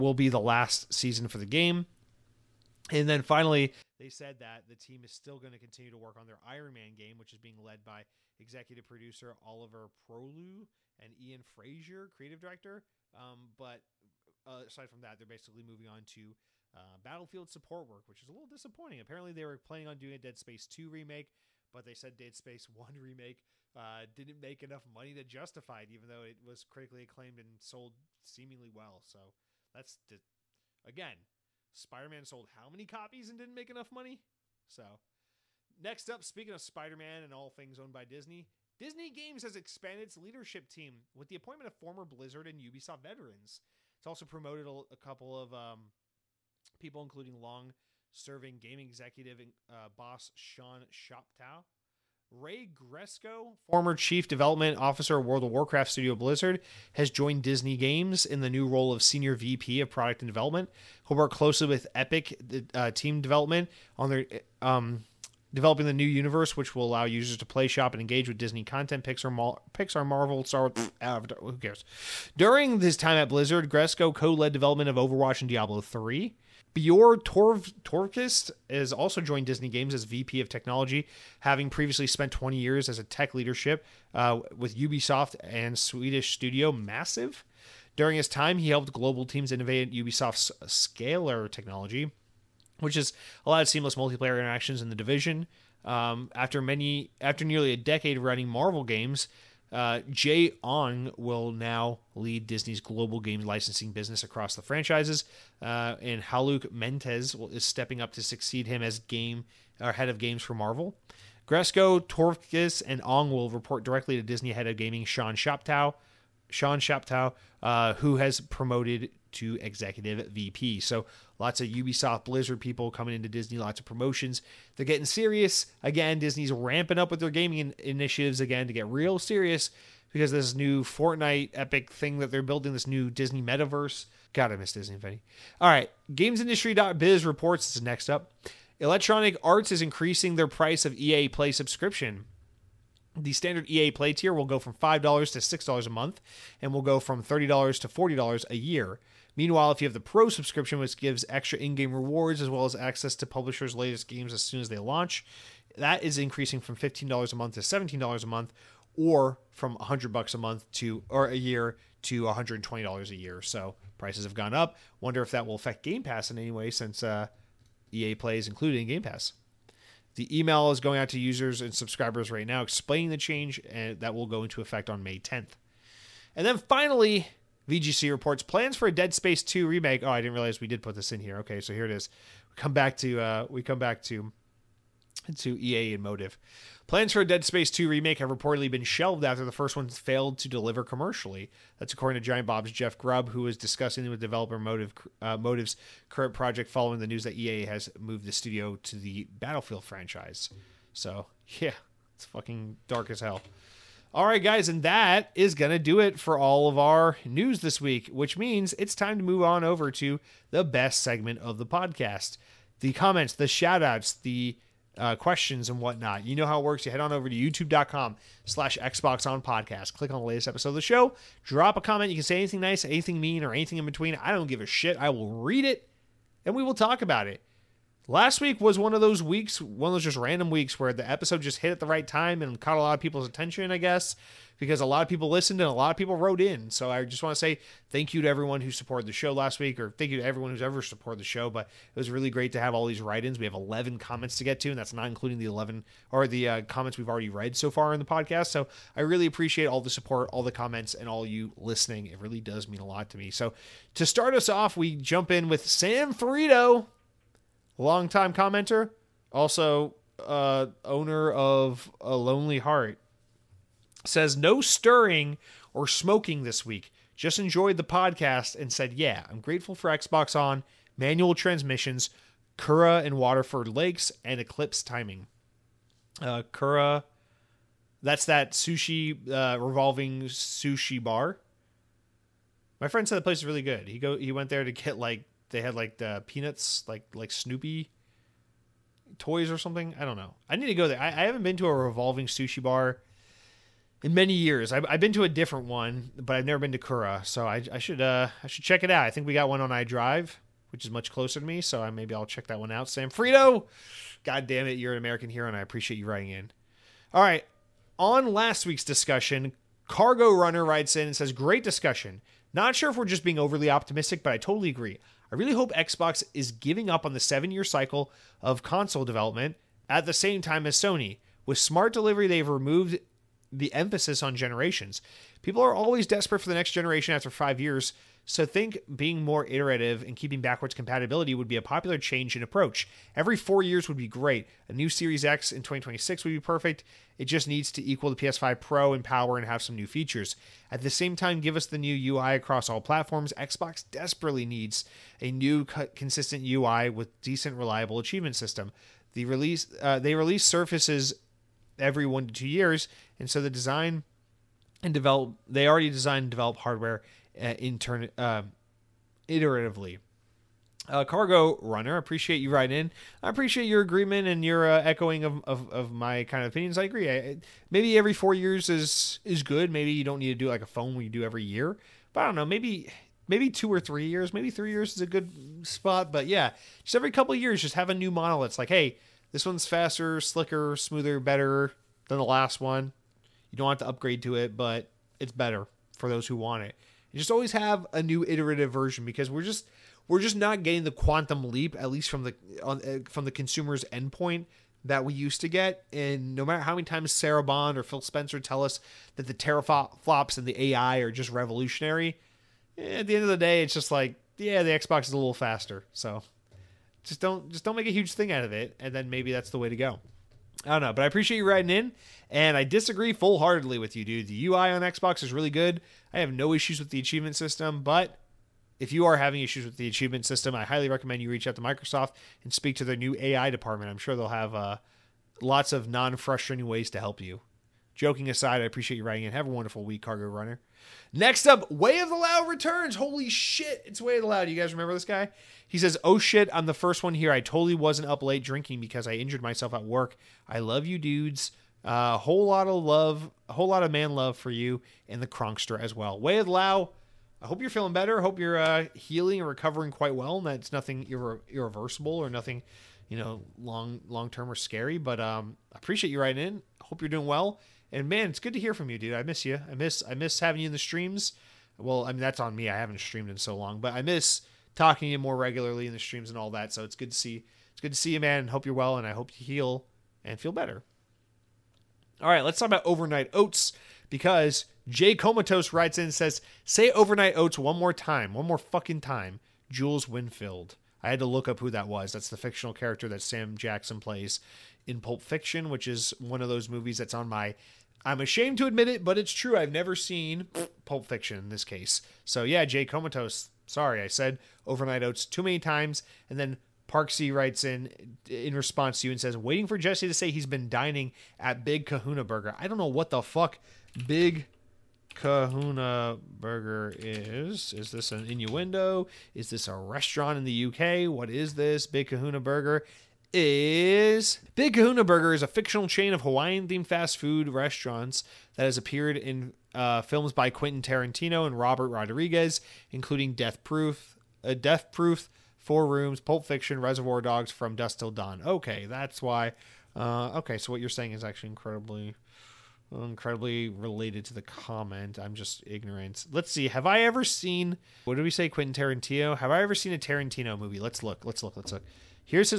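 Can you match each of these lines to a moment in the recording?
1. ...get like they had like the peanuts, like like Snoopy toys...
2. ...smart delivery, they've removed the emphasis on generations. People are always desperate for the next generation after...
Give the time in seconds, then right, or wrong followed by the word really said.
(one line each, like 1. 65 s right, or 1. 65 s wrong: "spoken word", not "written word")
1. 284 s right
2. 321 s right.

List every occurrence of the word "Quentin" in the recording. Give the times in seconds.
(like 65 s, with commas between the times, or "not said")
520 s, 538 s.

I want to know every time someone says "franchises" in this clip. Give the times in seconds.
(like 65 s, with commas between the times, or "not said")
104 s, 199 s.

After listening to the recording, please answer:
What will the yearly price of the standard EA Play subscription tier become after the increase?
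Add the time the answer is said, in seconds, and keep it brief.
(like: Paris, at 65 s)
$40, at 147 s.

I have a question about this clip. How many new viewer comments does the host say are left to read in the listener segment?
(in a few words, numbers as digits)
11.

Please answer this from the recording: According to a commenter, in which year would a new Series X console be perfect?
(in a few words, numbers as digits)
2026.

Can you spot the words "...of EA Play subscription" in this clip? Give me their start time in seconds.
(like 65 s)
140 s.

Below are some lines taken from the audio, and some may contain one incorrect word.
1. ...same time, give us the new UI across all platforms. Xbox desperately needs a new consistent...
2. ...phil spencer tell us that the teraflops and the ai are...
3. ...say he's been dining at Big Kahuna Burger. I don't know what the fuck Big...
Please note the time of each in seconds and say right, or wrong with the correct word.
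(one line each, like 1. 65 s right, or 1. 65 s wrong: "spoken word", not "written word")
1. 340 s right
2. 397 s right
3. 500 s right.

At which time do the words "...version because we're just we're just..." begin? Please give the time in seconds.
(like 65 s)
388 s.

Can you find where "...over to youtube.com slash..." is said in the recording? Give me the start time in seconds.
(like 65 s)
217 s.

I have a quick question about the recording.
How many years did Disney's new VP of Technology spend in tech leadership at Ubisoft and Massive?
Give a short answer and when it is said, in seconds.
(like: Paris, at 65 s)
20, at 82 s.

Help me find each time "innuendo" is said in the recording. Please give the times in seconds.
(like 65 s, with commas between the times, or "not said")
508 s.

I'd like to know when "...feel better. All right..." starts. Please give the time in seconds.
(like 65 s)
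470 s.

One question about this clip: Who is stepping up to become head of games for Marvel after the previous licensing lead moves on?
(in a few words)
Haluk Mentes.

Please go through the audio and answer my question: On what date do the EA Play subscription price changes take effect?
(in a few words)
May 10th.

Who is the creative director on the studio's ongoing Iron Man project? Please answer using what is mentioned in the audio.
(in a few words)
Ian Frazier.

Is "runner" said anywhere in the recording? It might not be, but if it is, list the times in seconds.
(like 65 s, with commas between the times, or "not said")
310 s, 361 s, 430 s.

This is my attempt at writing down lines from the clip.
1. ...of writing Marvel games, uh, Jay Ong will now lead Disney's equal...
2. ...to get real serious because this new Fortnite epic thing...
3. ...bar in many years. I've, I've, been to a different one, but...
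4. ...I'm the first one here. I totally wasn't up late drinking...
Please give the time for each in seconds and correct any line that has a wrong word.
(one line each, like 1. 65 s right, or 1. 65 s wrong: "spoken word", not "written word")
1. 98 s wrong: "global", not "equal"
2. 128 s right
3. 292 s right
4. 436 s right.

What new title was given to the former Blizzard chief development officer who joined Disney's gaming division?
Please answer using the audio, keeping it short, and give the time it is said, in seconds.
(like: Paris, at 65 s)
Senior VP of product and development, at 59 s.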